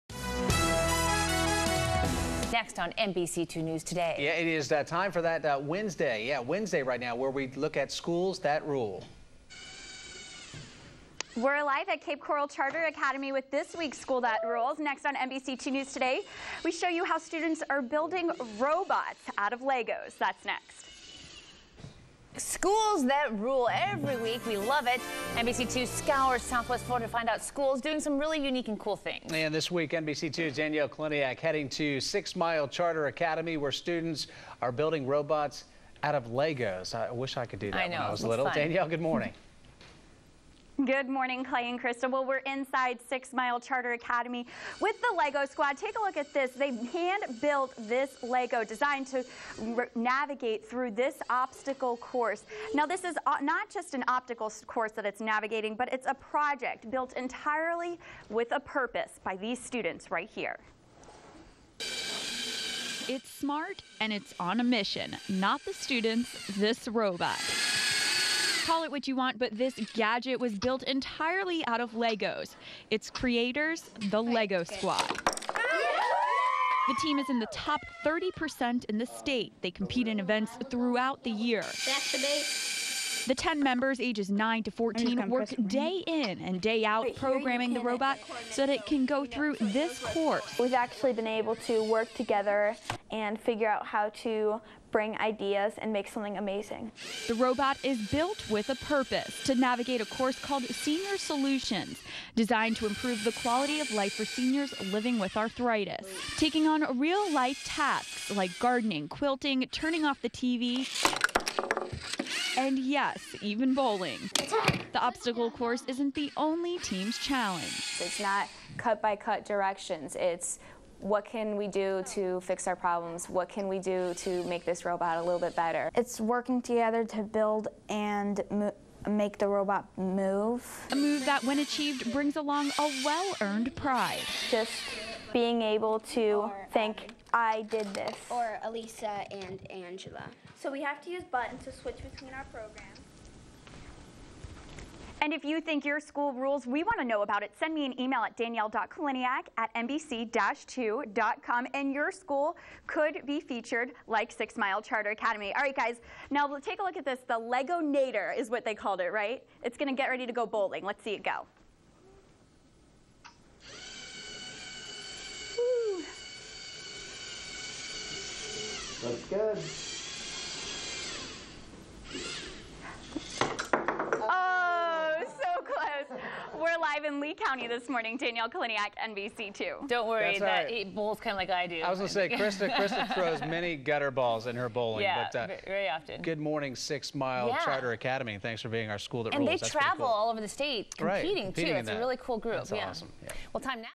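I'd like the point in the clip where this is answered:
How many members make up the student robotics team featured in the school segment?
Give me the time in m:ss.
1:23.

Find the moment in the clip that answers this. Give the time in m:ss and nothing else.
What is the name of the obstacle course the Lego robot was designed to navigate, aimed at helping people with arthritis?
1:40.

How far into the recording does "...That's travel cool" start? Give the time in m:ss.
3:09.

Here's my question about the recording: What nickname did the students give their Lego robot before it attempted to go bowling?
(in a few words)
Lego Nader.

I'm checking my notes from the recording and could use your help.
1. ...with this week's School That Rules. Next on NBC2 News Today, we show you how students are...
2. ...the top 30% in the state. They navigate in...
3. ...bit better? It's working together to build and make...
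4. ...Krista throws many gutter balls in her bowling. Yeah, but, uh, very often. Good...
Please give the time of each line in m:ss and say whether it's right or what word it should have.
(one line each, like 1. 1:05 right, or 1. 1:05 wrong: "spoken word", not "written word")
1. 0:13 right
2. 1:17 wrong: "compete", not "navigate"
3. 2:05 right
4. 3:02 right.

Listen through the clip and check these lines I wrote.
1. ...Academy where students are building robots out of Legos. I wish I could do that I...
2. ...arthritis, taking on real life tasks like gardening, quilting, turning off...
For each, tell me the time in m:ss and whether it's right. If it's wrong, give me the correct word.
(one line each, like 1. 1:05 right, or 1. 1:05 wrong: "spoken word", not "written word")
1. 0:33 right
2. 1:45 right.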